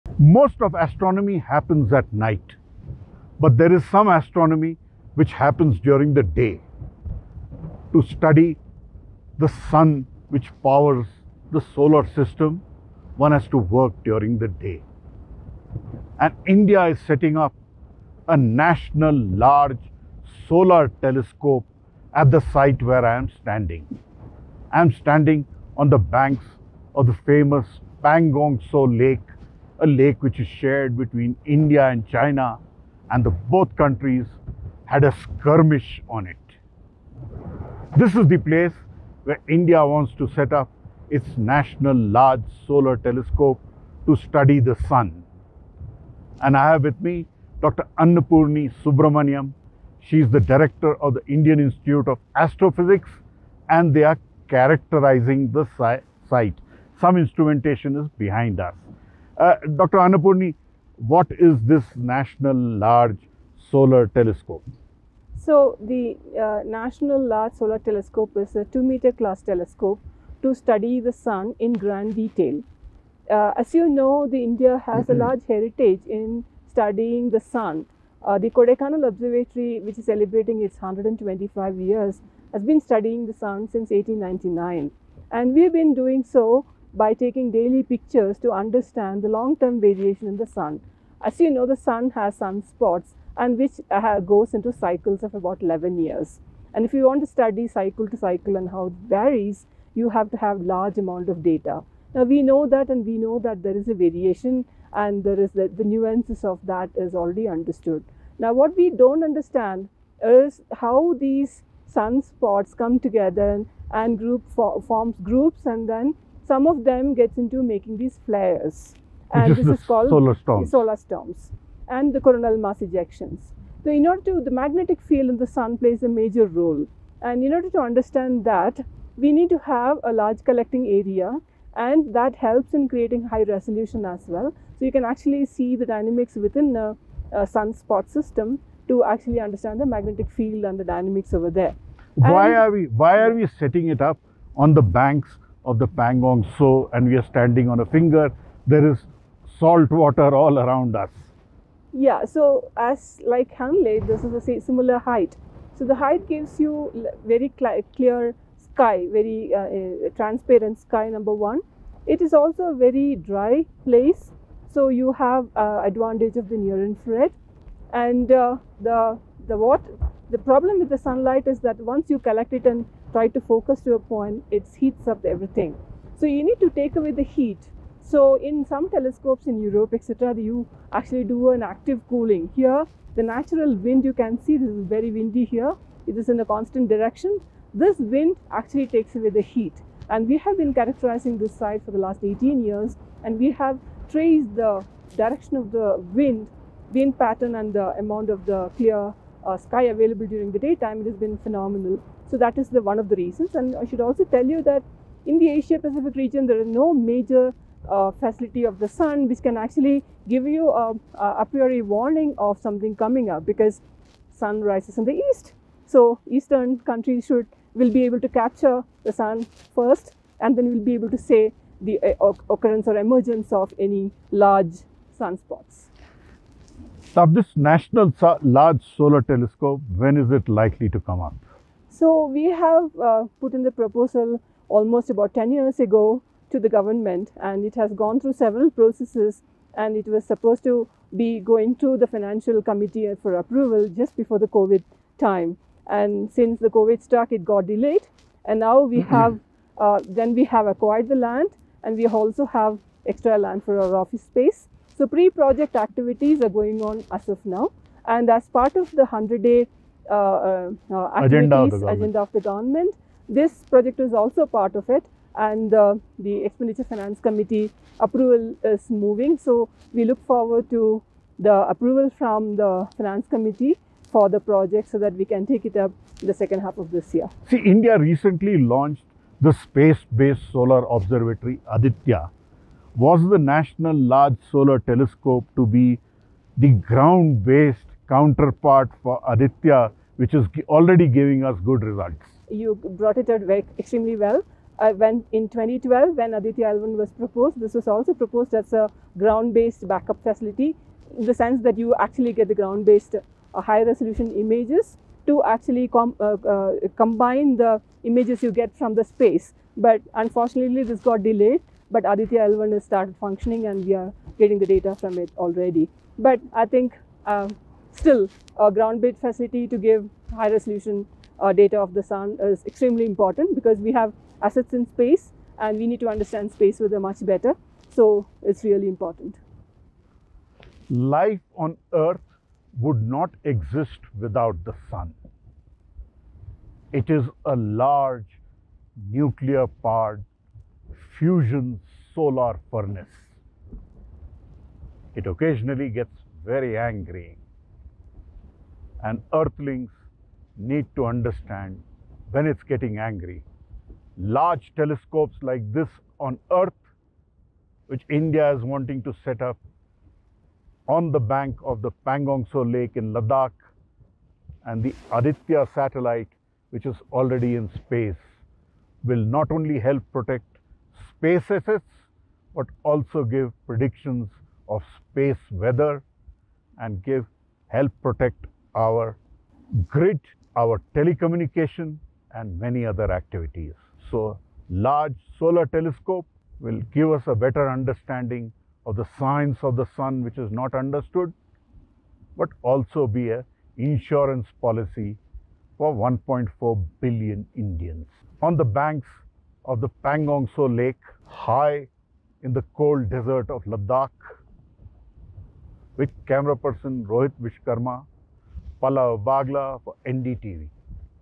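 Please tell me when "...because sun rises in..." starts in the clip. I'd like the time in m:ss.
3:33.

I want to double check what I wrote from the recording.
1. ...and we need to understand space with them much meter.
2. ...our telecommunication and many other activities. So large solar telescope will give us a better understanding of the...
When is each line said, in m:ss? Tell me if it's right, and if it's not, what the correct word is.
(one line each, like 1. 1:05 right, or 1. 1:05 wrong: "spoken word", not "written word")
1. 5:25 wrong: "better", not "meter"
2. 6:20 right.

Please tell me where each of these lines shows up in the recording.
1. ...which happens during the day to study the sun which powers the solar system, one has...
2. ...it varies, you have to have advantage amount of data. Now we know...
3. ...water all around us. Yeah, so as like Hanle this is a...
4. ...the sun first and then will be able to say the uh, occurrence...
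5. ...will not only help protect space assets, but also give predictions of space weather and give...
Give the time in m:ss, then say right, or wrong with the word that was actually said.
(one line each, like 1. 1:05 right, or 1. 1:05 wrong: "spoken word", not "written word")
1. 0:05 right
2. 1:38 wrong: "large", not "advantage"
3. 2:29 right
4. 3:39 right
5. 6:09 right.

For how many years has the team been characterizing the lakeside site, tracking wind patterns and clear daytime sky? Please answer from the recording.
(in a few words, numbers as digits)
18 years.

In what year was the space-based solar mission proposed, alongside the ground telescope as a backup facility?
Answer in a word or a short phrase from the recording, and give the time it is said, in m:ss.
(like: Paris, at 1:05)
2012, at 4:55.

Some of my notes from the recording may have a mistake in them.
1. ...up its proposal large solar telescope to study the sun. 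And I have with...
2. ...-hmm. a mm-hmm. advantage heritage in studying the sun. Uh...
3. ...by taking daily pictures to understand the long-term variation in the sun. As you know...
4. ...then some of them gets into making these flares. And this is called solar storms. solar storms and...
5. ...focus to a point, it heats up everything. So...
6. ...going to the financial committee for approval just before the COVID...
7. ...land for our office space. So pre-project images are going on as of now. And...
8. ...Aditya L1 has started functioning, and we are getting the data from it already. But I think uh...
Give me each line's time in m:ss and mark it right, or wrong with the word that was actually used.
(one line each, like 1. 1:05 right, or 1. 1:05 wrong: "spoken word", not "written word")
1. 0:40 wrong: "national", not "proposal"
2. 1:14 wrong: "large", not "advantage"
3. 1:26 right
4. 1:55 right
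5. 2:53 right
6. 4:01 right
7. 4:13 wrong: "activities", not "images"
8. 5:12 right.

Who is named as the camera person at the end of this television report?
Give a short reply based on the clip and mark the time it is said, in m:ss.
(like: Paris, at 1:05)
Rohit Vishwakarma, at 6:47.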